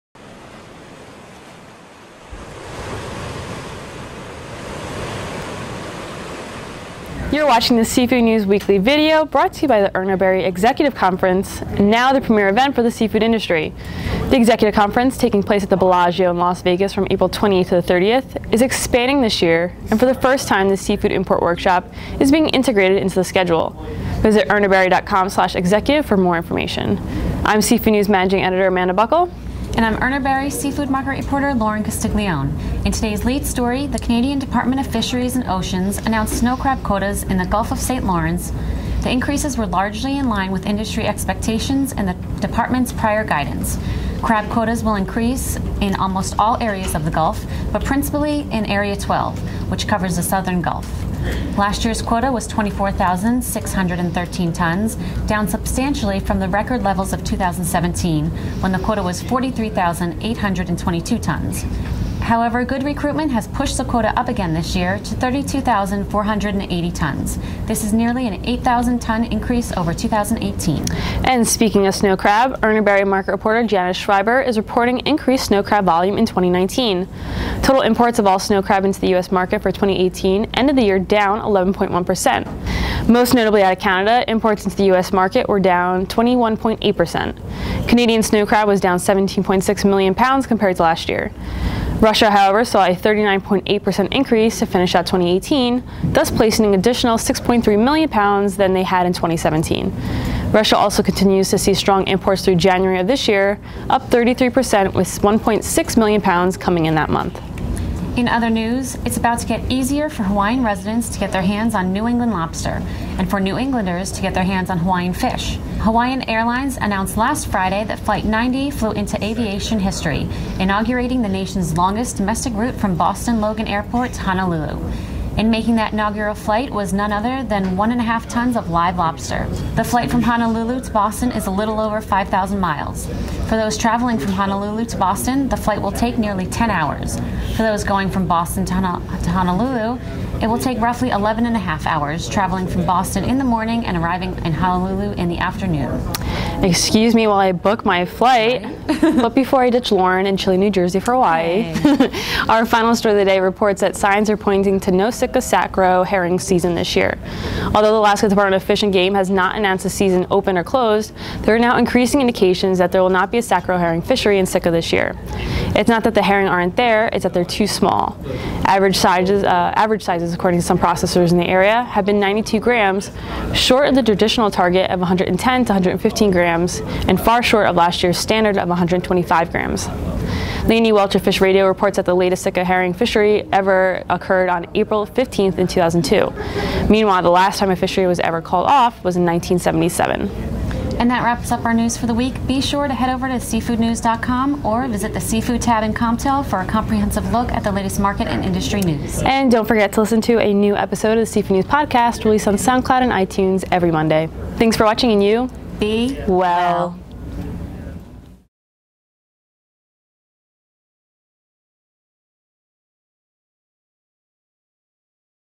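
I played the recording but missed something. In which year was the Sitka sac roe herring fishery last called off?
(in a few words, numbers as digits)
1977.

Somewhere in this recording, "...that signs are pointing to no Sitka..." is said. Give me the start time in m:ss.
2:33.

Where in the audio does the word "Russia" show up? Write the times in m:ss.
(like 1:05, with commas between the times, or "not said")
1:32, 1:40.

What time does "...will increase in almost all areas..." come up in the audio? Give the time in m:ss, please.
0:44.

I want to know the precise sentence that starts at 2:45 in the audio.
It's not that the herring aren't there, it's that they're too small.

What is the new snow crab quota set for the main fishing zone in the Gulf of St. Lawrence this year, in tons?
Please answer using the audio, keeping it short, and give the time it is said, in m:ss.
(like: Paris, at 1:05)
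32,480 tons, at 1:05.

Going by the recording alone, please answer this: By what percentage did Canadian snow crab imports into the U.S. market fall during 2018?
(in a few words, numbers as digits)
21.8%.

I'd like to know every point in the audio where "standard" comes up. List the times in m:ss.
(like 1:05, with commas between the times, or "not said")
2:58.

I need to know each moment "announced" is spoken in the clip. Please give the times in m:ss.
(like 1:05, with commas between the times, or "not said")
0:35, 1:56, 2:39.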